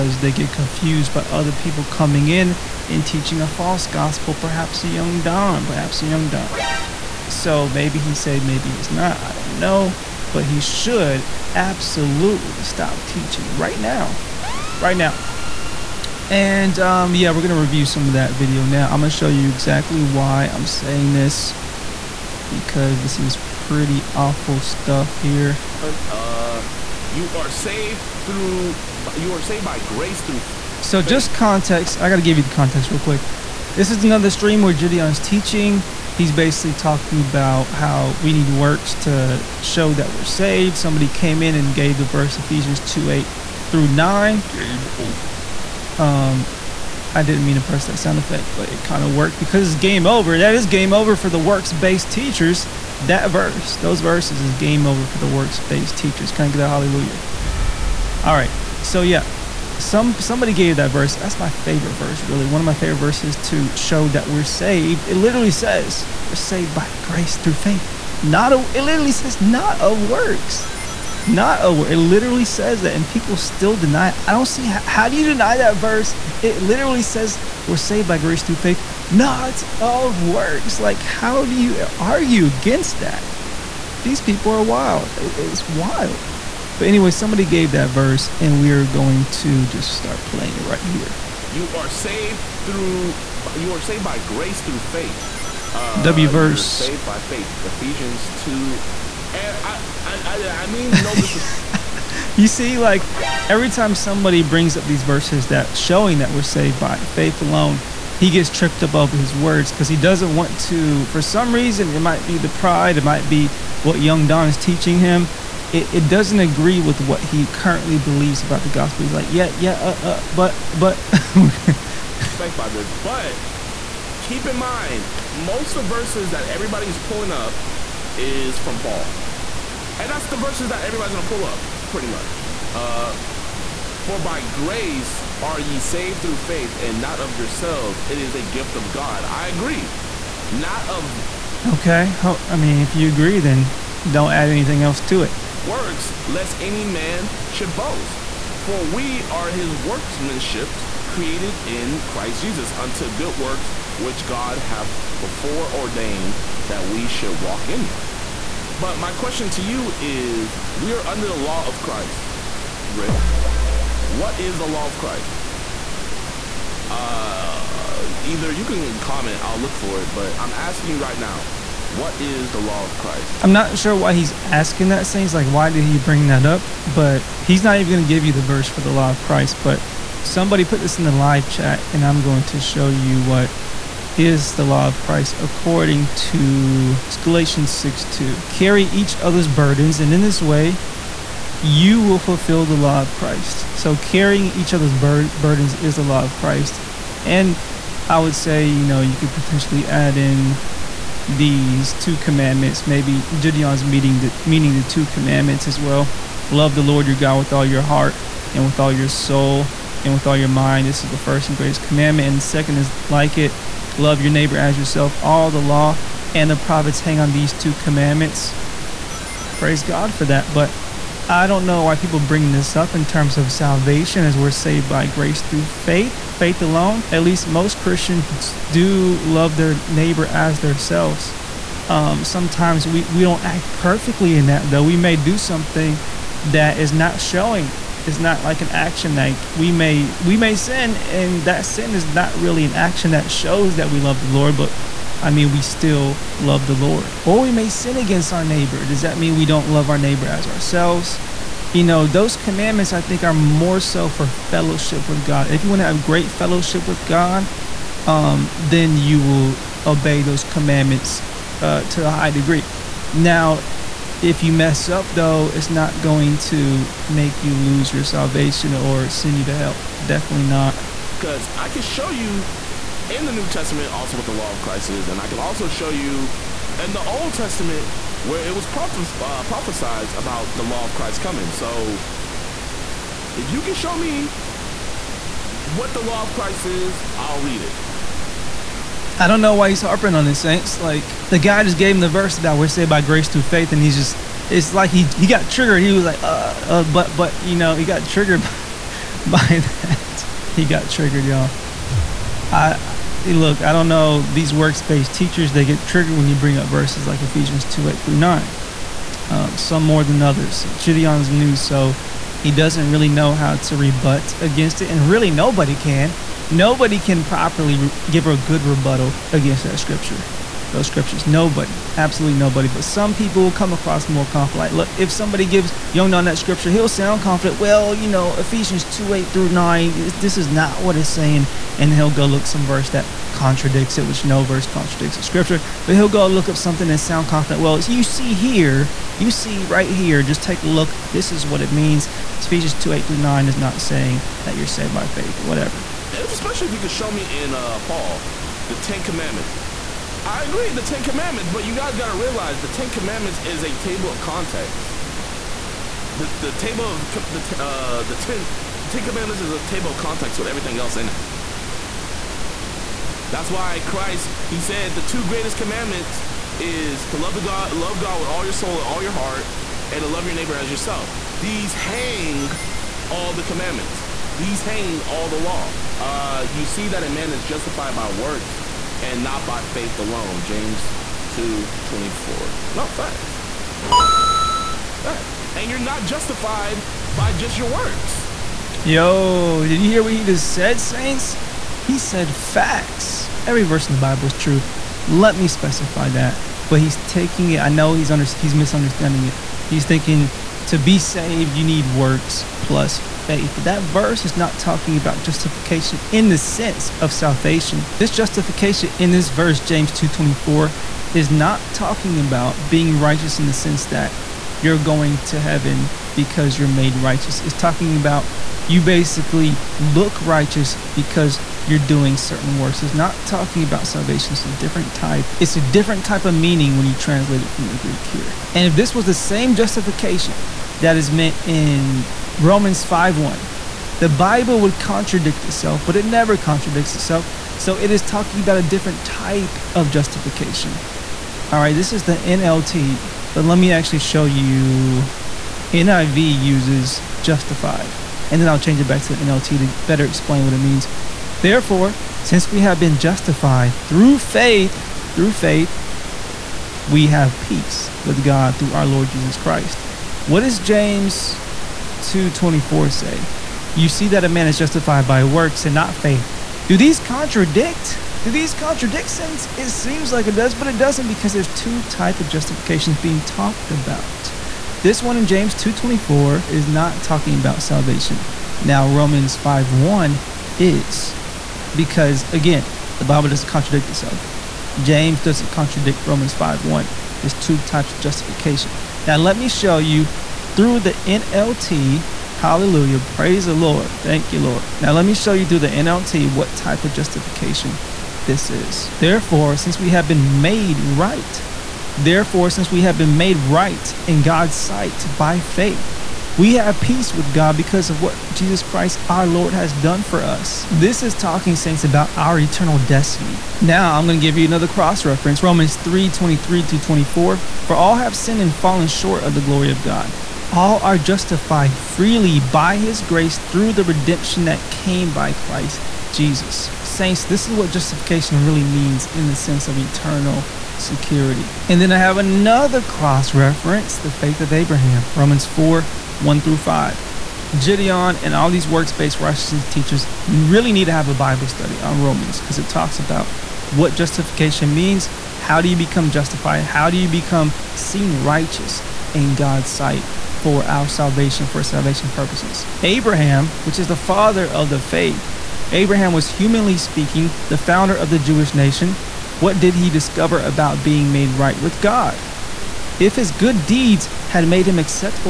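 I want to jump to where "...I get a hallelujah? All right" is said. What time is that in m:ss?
0:56.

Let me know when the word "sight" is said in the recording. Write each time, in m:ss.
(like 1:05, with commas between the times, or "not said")
8:24, 9:09.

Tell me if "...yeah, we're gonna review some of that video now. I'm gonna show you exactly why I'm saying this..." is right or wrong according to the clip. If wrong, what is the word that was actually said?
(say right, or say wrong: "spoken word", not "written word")
right.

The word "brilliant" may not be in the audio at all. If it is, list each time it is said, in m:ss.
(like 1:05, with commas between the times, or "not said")
not said.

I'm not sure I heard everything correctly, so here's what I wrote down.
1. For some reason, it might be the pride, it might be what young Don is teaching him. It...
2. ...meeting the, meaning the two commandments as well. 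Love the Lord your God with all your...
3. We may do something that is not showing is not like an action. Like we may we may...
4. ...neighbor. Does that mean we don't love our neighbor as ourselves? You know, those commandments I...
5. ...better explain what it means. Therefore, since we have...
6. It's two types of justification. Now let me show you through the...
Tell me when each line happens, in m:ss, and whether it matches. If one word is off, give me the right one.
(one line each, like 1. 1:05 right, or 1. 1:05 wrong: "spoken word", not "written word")
1. 1:51 right
2. 3:23 right
3. 3:54 right
4. 4:08 right
5. 7:29 right
6. 8:07 right.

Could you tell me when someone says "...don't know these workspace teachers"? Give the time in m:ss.
5:03.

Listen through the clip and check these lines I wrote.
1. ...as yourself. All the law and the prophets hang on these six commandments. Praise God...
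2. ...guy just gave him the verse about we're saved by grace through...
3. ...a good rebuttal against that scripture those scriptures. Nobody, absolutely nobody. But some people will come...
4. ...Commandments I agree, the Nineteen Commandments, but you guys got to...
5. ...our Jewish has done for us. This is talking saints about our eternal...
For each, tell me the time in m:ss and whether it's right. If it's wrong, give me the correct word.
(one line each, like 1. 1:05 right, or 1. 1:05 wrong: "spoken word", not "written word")
1. 3:34 wrong: "two", not "six"
2. 4:51 right
3. 5:18 right
4. 5:49 wrong: "Ten", not "Nineteen"
5. 8:29 wrong: "Lord", not "Jewish".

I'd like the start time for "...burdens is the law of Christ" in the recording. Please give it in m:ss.
3:15.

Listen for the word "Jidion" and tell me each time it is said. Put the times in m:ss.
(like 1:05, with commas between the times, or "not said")
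0:34, 3:23, 5:10, 8:57.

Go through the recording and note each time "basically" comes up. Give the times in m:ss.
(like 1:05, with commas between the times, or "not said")
0:36, 6:58.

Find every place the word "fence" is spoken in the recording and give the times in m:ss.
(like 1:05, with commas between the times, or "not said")
not said.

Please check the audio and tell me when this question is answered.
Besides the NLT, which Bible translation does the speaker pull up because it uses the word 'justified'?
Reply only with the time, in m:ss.
7:25.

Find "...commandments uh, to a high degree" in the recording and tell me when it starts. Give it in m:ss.
4:20.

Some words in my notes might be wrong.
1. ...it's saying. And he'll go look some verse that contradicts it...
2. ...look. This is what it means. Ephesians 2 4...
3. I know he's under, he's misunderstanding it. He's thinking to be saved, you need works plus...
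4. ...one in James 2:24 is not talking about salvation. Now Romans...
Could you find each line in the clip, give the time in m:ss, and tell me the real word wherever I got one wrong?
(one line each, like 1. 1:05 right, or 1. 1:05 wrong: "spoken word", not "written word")
1. 5:30 right
2. 5:40 wrong: "8", not "4"
3. 6:37 right
4. 7:55 right.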